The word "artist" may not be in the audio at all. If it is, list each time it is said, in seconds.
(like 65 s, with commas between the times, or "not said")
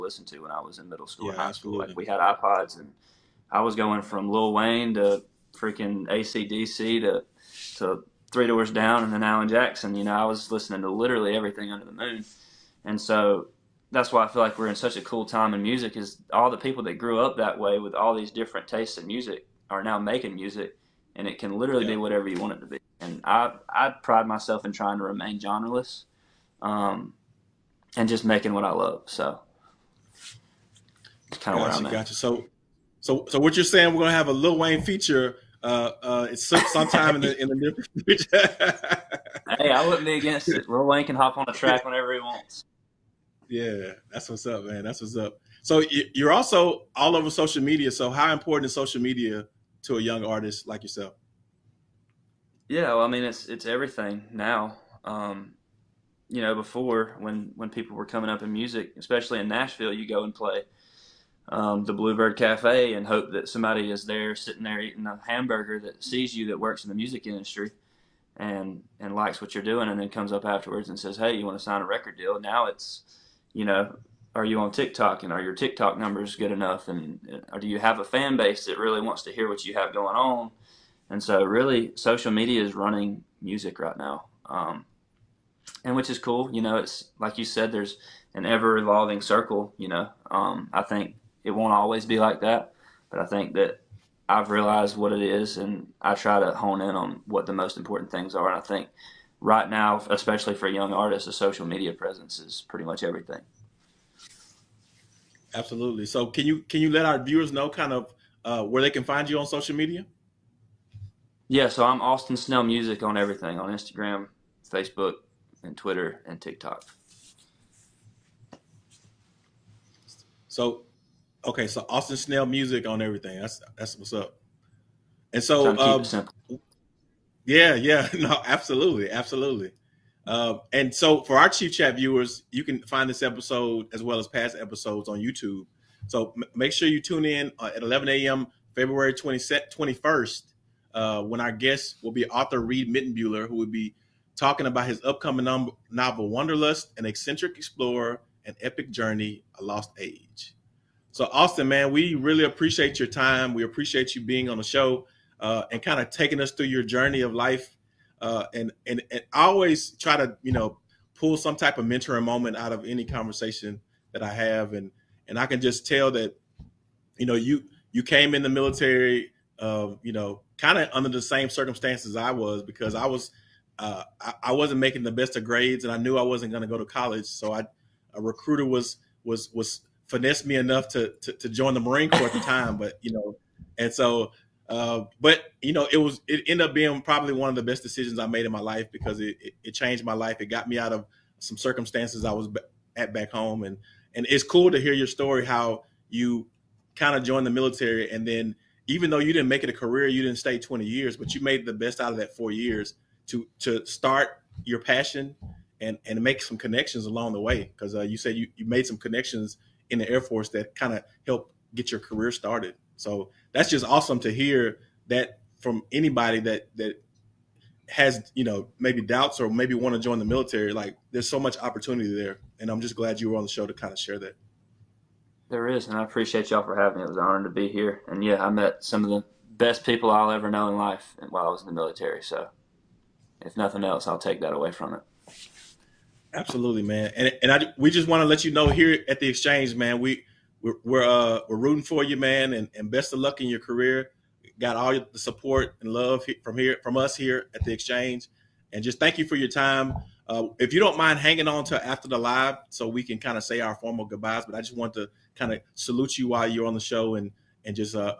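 50 s, 100 s.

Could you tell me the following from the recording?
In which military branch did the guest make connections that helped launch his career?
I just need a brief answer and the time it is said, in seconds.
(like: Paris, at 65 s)
Air Force, at 210 s.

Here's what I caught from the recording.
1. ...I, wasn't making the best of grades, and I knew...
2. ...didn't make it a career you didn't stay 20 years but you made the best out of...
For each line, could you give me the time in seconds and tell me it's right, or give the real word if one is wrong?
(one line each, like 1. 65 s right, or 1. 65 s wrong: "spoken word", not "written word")
1. 174 s right
2. 199 s right.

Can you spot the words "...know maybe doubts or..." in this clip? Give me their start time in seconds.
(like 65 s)
218 s.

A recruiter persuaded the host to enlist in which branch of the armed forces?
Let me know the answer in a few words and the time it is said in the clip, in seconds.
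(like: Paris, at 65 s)
Marine Corps, at 181 s.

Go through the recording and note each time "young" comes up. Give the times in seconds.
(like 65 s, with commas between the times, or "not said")
50 s, 100 s.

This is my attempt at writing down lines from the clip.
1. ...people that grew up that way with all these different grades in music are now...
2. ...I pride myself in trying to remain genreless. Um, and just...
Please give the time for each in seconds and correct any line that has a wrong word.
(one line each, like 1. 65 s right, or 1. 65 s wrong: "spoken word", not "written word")
1. 16 s wrong: "tastes", not "grades"
2. 23 s right.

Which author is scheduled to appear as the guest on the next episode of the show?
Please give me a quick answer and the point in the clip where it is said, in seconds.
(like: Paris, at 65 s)
Reid Mitenbuler, at 142 s.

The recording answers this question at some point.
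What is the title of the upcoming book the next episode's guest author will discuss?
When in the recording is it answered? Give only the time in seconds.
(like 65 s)
146 s.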